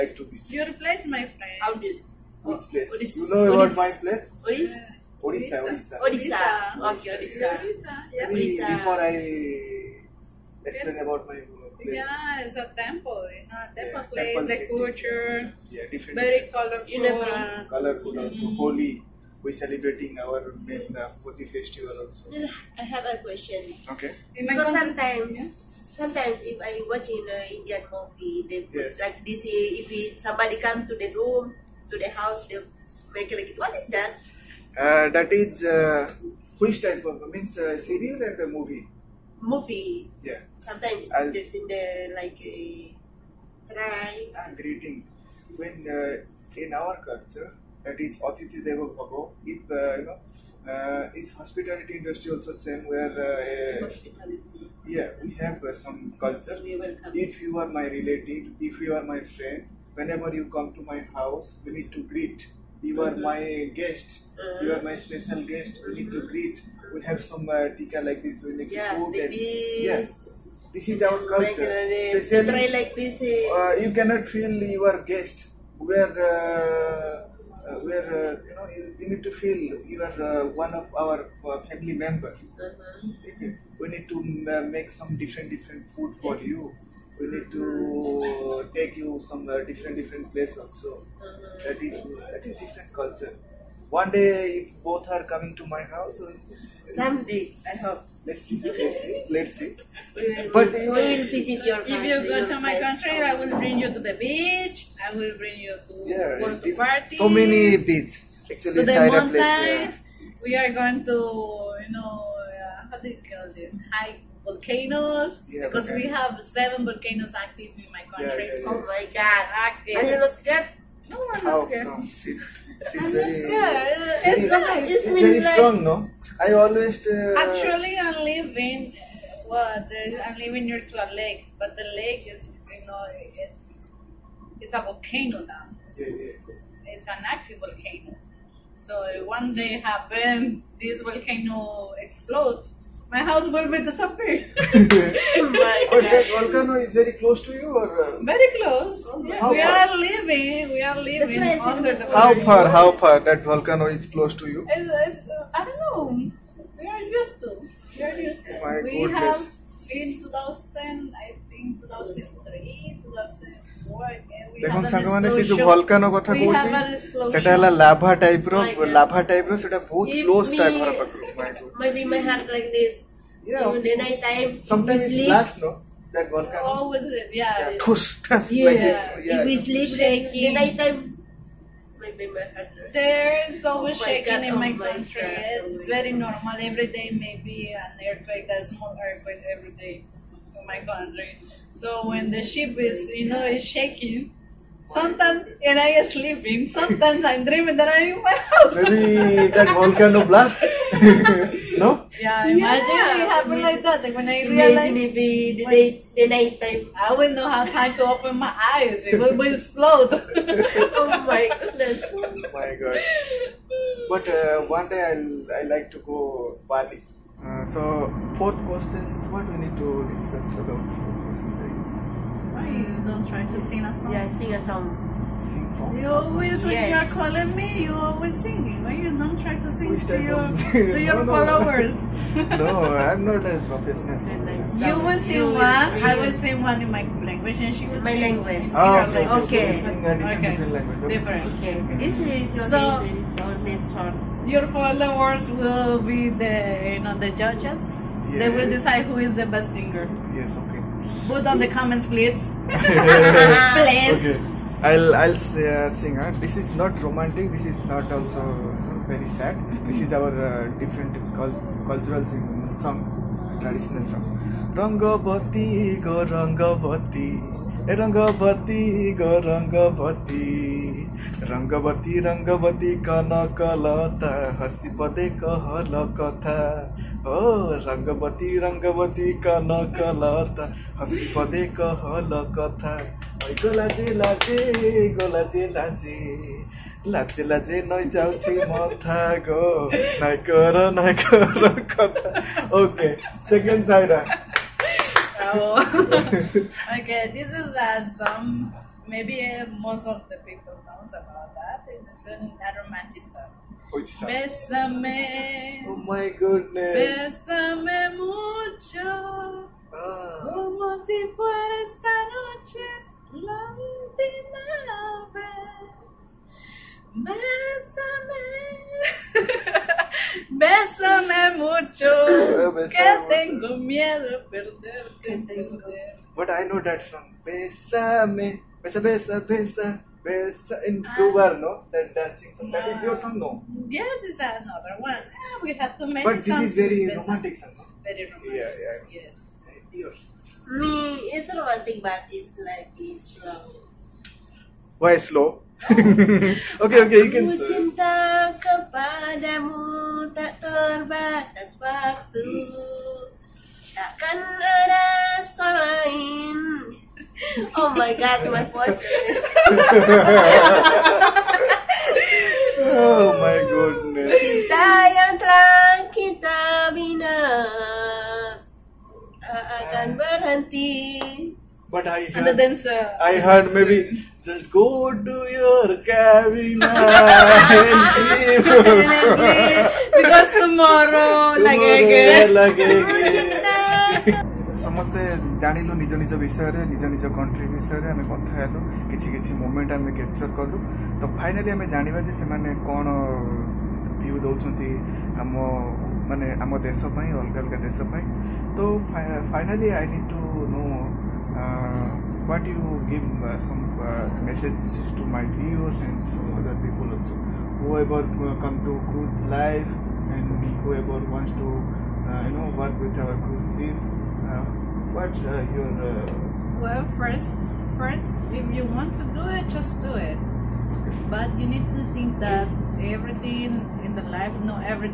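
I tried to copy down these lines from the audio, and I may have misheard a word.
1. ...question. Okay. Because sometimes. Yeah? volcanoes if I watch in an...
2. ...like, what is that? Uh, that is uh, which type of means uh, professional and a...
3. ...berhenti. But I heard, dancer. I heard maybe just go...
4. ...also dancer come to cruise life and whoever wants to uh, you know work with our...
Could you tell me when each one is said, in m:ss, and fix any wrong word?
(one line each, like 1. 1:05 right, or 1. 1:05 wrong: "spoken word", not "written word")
1. 0:23 wrong: "sometimes", not "volcanoes"
2. 0:33 wrong: "serial", not "professional"
3. 6:10 right
4. 6:47 wrong: "whoever", not "dancer".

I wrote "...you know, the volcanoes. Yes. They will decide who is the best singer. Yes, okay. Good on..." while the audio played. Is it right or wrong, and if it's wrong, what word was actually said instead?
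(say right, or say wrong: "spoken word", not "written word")
wrong: "judges", not "volcanoes".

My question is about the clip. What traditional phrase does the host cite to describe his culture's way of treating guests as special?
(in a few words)
Atiti Deva Bhava.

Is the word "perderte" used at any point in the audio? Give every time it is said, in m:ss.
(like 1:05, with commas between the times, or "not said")
5:24.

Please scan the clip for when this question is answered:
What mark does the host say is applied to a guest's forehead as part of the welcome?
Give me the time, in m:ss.
1:07.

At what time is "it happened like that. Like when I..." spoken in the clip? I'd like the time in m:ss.
3:23.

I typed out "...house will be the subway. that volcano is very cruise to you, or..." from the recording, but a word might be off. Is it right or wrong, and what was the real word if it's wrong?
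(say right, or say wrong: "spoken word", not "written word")
wrong: "close", not "cruise".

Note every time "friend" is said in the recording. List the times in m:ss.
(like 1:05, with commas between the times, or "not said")
0:01, 0:59.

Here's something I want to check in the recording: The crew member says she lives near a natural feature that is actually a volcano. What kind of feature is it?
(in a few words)
a lake.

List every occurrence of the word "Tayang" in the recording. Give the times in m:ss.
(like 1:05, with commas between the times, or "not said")
6:04.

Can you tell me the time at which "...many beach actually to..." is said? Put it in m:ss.
1:47.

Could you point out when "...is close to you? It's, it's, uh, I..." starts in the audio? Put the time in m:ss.
2:33.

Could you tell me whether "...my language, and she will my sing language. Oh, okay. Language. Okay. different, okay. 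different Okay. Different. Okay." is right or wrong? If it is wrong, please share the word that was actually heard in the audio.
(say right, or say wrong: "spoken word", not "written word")
right.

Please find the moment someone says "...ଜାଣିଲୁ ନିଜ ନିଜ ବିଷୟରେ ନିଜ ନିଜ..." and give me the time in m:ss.
6:25.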